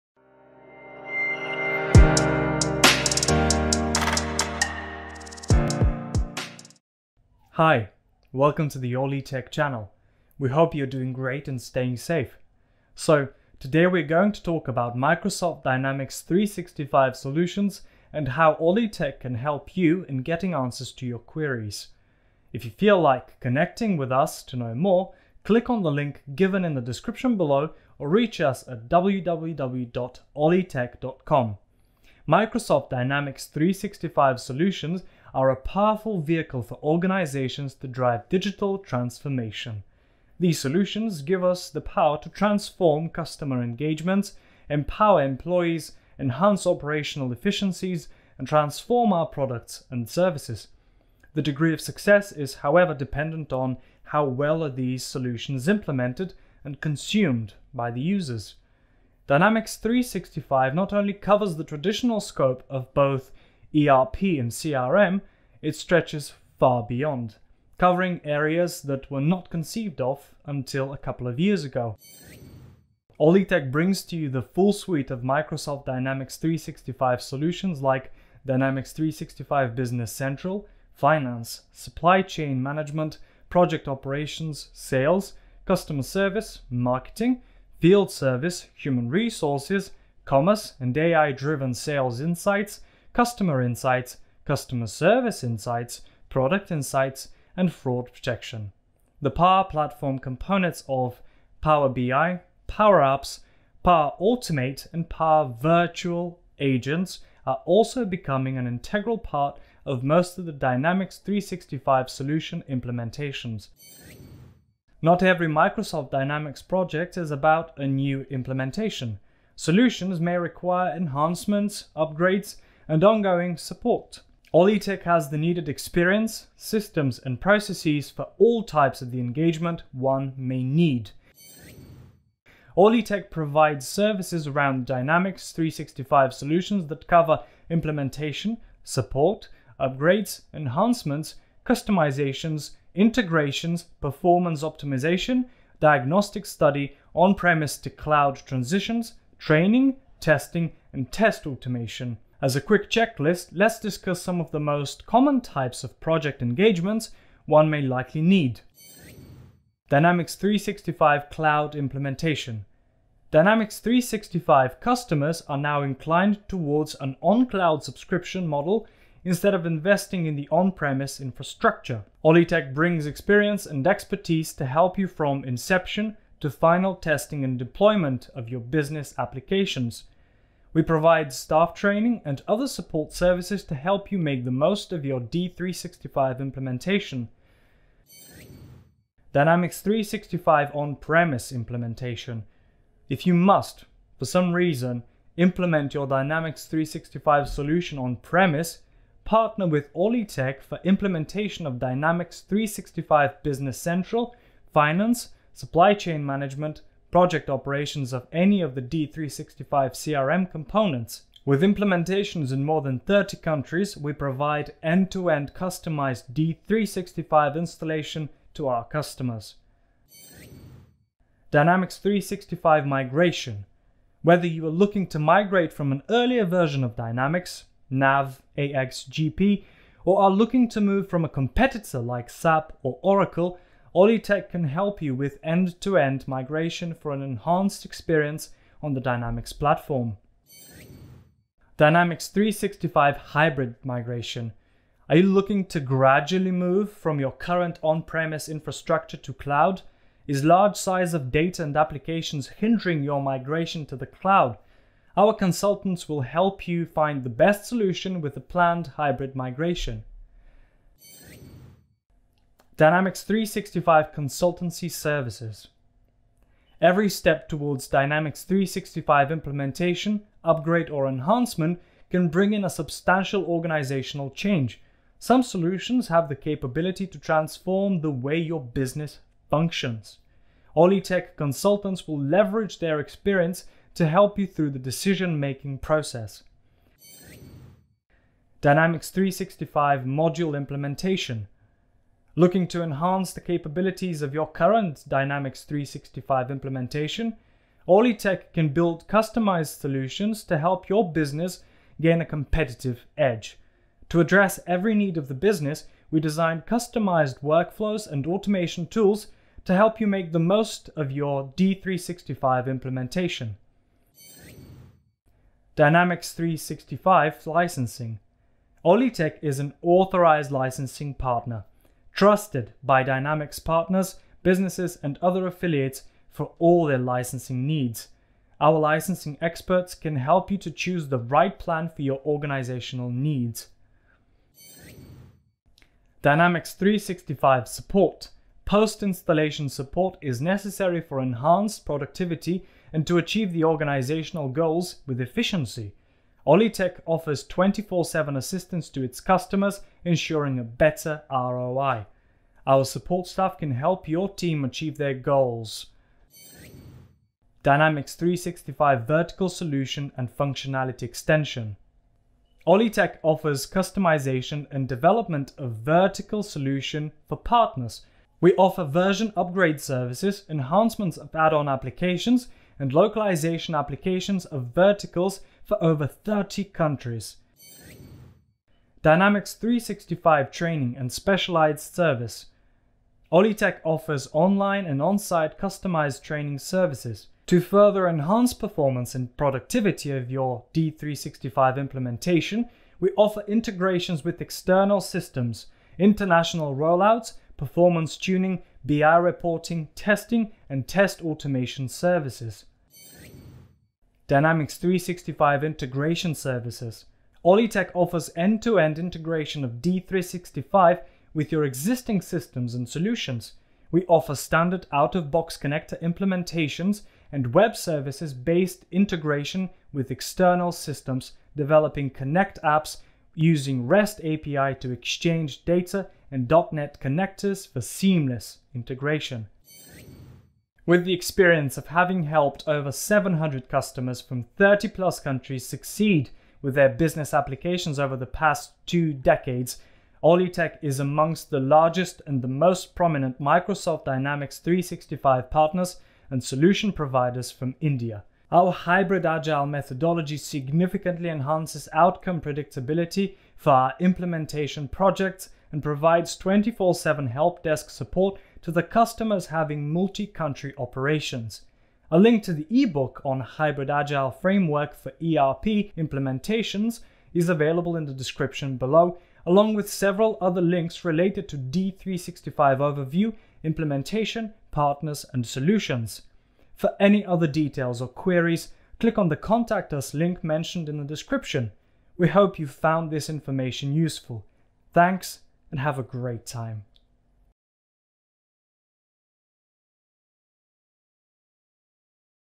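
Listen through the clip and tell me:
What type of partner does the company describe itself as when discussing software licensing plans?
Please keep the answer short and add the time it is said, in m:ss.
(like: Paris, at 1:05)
authorized licensing partner, at 5:19.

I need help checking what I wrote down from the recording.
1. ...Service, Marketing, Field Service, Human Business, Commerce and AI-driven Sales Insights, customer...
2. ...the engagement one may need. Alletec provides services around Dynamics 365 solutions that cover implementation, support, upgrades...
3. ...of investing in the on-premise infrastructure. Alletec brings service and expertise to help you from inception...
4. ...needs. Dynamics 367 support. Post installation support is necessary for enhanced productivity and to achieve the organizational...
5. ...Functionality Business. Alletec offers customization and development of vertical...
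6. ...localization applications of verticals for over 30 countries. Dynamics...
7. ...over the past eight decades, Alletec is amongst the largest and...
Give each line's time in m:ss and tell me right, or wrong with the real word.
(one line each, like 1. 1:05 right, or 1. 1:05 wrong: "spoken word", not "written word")
1. 1:26 wrong: "Resources", not "Business"
2. 2:09 right
3. 2:49 wrong: "experience", not "service"
4. 5:33 wrong: "365", not "367"
5. 6:00 wrong: "Extension", not "Business"
6. 6:12 right
7. 7:17 wrong: "two", not "eight".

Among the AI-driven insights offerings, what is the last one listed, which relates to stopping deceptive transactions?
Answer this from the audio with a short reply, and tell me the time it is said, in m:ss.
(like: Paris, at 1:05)
fraud protection, at 1:37.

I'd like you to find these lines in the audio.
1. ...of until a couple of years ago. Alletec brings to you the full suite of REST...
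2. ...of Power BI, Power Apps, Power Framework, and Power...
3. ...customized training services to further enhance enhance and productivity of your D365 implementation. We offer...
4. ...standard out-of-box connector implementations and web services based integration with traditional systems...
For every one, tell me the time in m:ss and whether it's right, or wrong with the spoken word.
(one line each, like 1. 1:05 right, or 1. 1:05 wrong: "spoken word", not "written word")
1. 1:10 wrong: "Microsoft", not "REST"
2. 1:40 wrong: "Automate", not "Framework"
3. 6:25 wrong: "performance", not "enhance"
4. 6:54 wrong: "external", not "traditional".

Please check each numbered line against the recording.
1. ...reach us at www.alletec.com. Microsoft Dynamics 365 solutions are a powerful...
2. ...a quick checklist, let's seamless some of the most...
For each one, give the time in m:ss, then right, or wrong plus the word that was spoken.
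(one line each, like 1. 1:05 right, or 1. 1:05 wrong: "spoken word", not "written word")
1. 0:28 right
2. 2:32 wrong: "discuss", not "seamless".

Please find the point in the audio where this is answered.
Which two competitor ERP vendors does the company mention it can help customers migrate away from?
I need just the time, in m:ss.
3:52.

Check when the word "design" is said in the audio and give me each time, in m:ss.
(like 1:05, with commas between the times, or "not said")
5:06.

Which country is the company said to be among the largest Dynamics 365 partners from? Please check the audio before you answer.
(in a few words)
India.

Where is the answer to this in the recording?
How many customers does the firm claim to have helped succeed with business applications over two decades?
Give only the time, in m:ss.
7:12.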